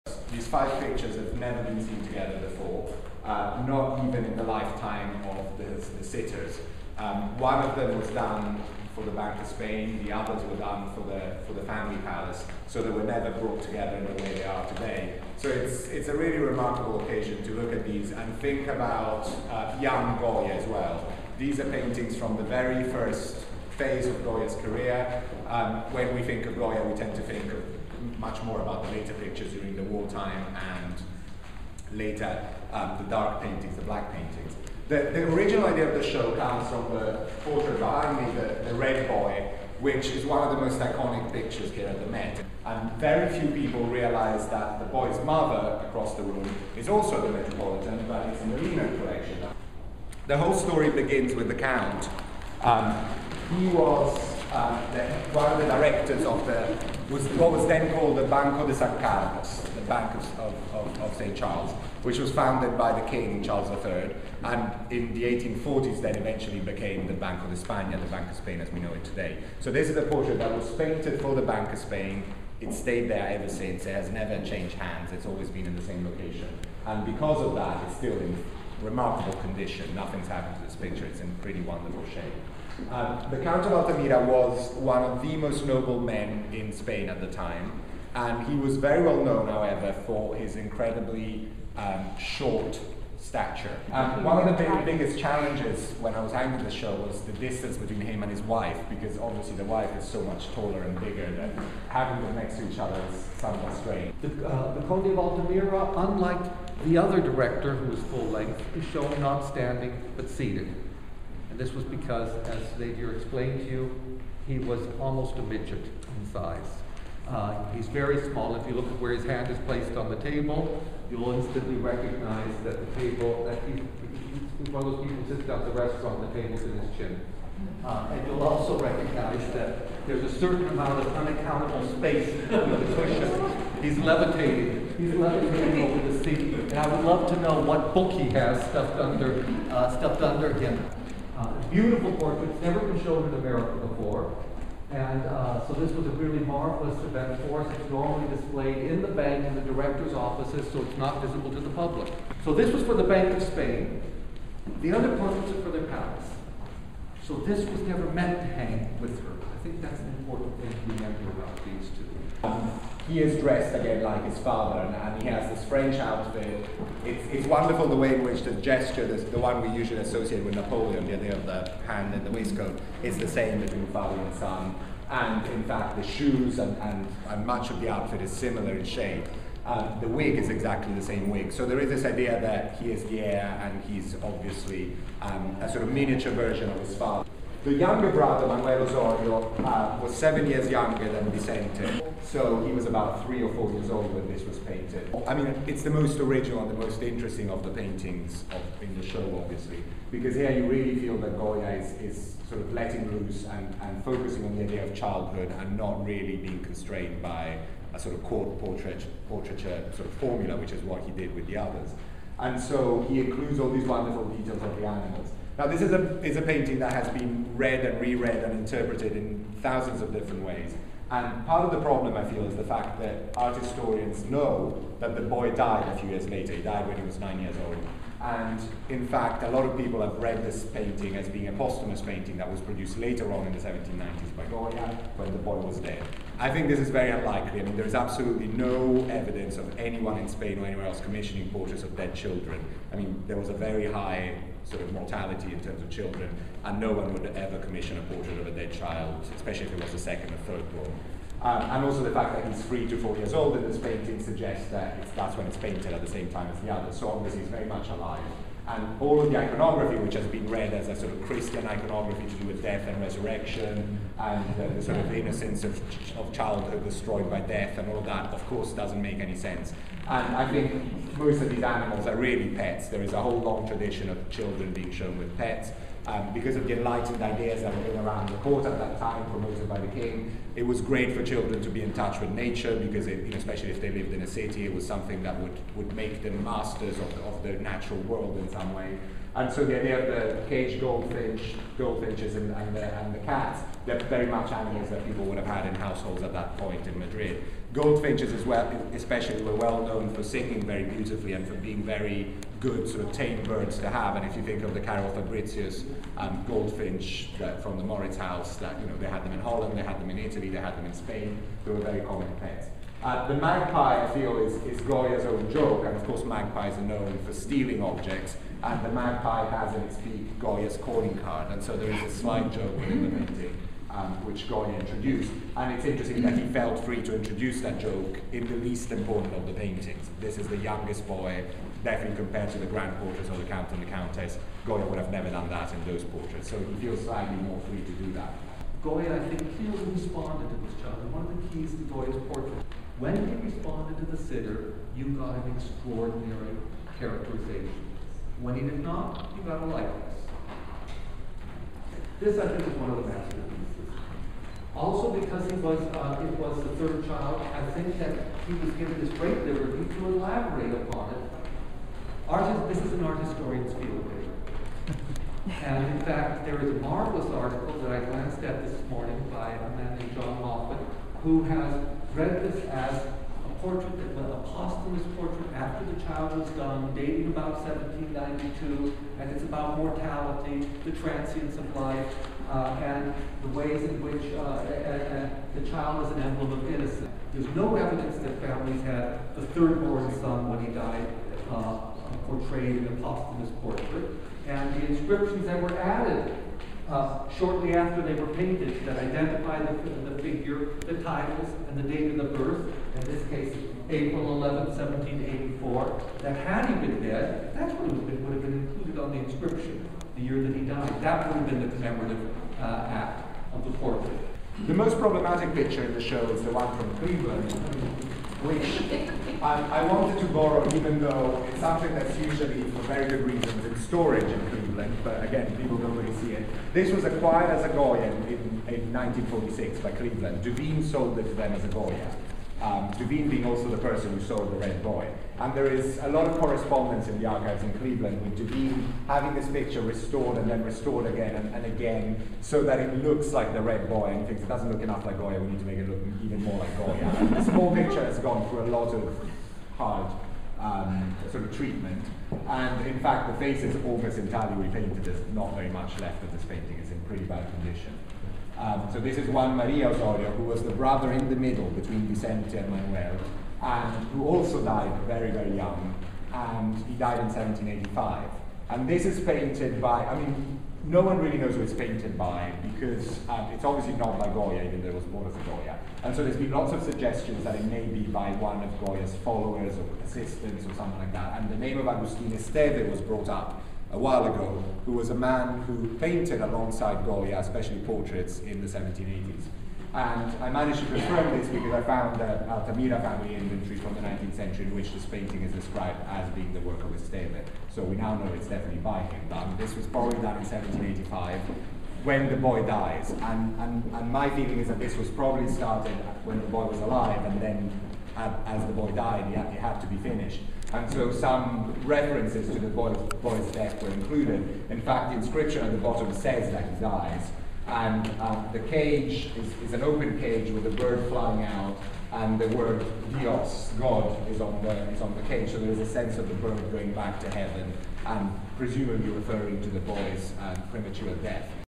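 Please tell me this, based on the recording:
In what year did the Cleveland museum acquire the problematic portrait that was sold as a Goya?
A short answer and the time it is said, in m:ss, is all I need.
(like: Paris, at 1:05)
1946, at 7:08.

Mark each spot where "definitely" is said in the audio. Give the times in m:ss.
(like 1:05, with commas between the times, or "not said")
5:31, 8:18.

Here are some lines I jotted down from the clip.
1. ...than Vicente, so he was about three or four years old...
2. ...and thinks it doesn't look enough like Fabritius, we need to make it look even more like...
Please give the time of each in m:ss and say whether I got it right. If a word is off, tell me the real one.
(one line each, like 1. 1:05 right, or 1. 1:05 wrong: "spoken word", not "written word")
1. 3:11 right
2. 7:24 wrong: "Goya", not "Fabritius".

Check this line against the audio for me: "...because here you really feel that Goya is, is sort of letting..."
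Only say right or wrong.
right.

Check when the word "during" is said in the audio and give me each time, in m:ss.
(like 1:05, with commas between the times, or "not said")
0:29.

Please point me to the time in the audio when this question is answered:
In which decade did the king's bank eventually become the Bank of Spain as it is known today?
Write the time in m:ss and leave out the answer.
1:05.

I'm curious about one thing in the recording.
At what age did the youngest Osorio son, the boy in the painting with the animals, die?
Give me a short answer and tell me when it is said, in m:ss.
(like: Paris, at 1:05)
9, at 3:47.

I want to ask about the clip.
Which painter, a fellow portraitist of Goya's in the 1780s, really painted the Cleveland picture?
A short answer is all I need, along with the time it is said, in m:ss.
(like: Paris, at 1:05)
Agustin Esteve, at 8:01.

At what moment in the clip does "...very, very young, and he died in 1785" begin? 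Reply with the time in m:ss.
7:45.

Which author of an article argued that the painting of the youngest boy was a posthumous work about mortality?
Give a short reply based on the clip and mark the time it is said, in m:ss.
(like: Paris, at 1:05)
John Moffitt, at 6:10.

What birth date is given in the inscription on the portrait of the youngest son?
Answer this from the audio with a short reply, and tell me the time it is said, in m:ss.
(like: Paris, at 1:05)
April 11, 1784, at 6:43.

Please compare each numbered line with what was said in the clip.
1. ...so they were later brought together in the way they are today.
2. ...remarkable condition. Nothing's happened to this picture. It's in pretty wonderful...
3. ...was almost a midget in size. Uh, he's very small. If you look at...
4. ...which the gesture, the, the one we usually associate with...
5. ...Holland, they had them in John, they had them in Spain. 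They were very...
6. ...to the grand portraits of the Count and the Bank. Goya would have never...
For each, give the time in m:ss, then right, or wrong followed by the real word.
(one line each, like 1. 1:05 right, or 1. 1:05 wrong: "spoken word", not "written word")
1. 0:12 wrong: "never", not "later"
2. 1:18 right
3. 1:54 right
4. 2:48 right
5. 5:09 wrong: "Italy", not "John"
6. 5:32 wrong: "Countess", not "Bank".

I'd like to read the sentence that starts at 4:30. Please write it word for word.
And I think most of these animals are really pets.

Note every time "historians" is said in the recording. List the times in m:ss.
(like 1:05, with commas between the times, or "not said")
3:43, 6:03.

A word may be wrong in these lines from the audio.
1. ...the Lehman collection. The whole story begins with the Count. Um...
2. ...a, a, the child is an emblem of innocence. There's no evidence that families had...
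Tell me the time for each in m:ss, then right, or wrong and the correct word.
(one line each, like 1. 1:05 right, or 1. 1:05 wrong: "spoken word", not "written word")
1. 0:48 right
2. 6:24 right.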